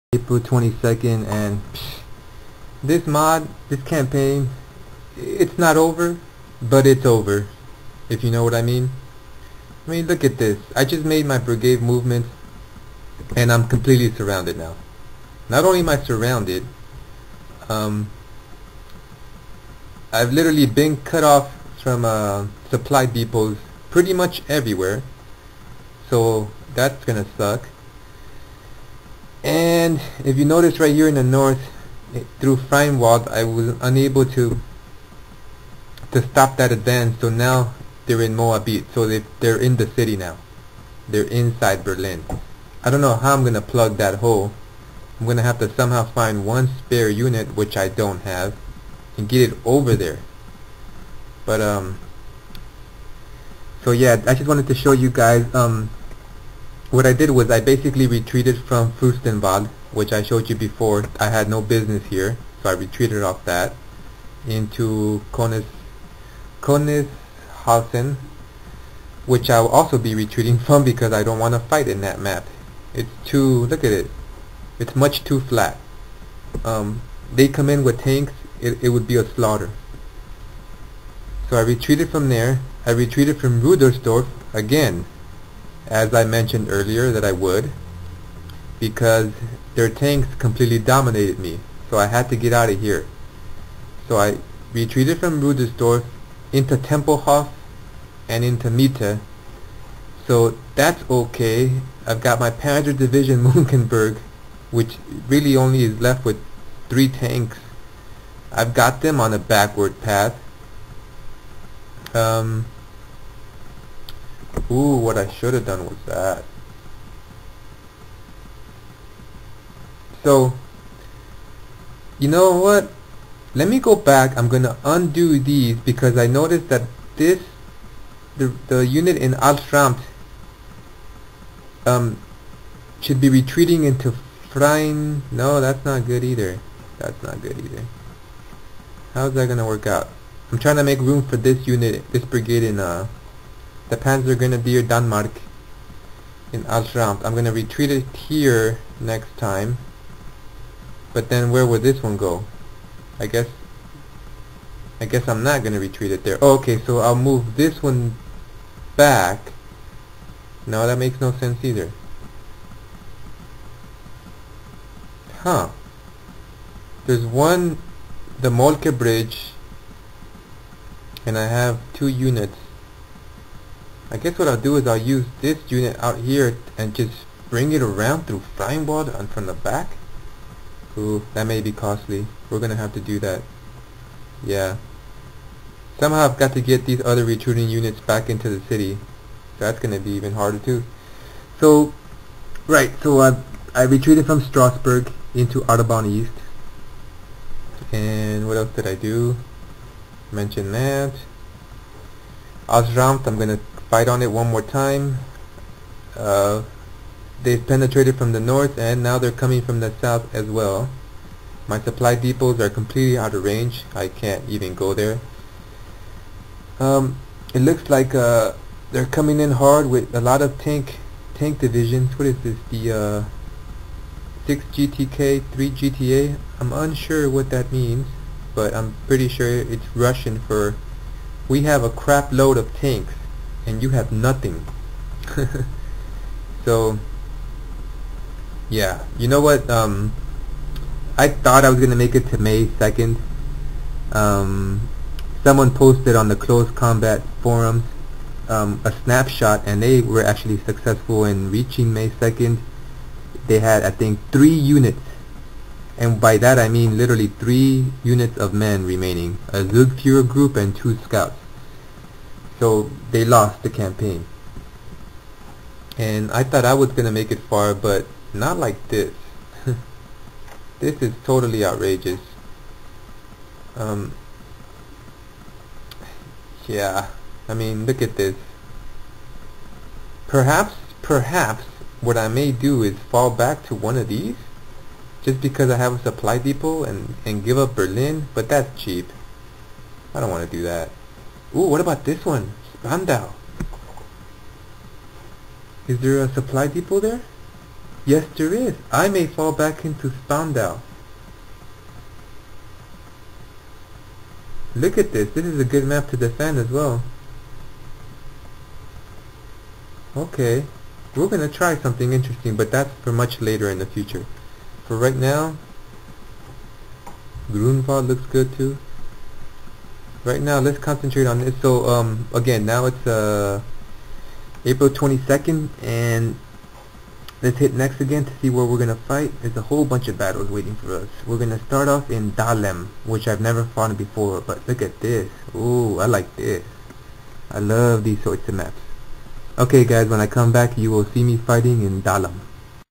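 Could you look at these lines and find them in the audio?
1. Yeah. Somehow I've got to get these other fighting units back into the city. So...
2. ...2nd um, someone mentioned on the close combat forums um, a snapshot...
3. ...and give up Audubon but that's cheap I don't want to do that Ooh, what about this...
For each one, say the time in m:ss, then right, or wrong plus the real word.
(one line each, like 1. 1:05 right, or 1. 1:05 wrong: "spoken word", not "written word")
1. 3:04 wrong: "retreating", not "fighting"
2. 4:02 wrong: "posted", not "mentioned"
3. 4:47 wrong: "Berlin", not "Audubon".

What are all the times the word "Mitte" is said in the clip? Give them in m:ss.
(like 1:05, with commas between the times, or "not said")
1:38.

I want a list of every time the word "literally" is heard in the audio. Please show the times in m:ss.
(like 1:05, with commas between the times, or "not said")
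0:20, 4:16.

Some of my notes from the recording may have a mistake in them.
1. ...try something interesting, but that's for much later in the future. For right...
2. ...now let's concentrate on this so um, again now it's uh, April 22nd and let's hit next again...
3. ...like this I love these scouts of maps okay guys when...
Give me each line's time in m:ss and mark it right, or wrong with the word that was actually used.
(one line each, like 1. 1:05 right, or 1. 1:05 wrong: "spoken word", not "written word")
1. 5:11 right
2. 5:20 right
3. 5:36 wrong: "sorts", not "scouts".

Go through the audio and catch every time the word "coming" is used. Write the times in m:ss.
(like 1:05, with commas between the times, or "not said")
3:29, 3:39.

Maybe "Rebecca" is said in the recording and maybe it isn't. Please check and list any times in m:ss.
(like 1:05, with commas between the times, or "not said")
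not said.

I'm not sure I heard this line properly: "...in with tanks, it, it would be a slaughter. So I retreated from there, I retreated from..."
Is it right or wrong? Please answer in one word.
right.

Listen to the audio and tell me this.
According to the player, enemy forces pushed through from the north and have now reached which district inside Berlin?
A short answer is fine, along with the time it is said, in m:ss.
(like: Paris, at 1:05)
Moabit, at 0:38.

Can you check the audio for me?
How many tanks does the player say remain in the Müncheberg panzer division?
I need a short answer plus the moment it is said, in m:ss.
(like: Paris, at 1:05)
3, at 1:46.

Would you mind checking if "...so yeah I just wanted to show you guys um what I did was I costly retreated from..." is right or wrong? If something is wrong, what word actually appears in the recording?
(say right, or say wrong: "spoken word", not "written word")
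wrong: "basically", not "costly".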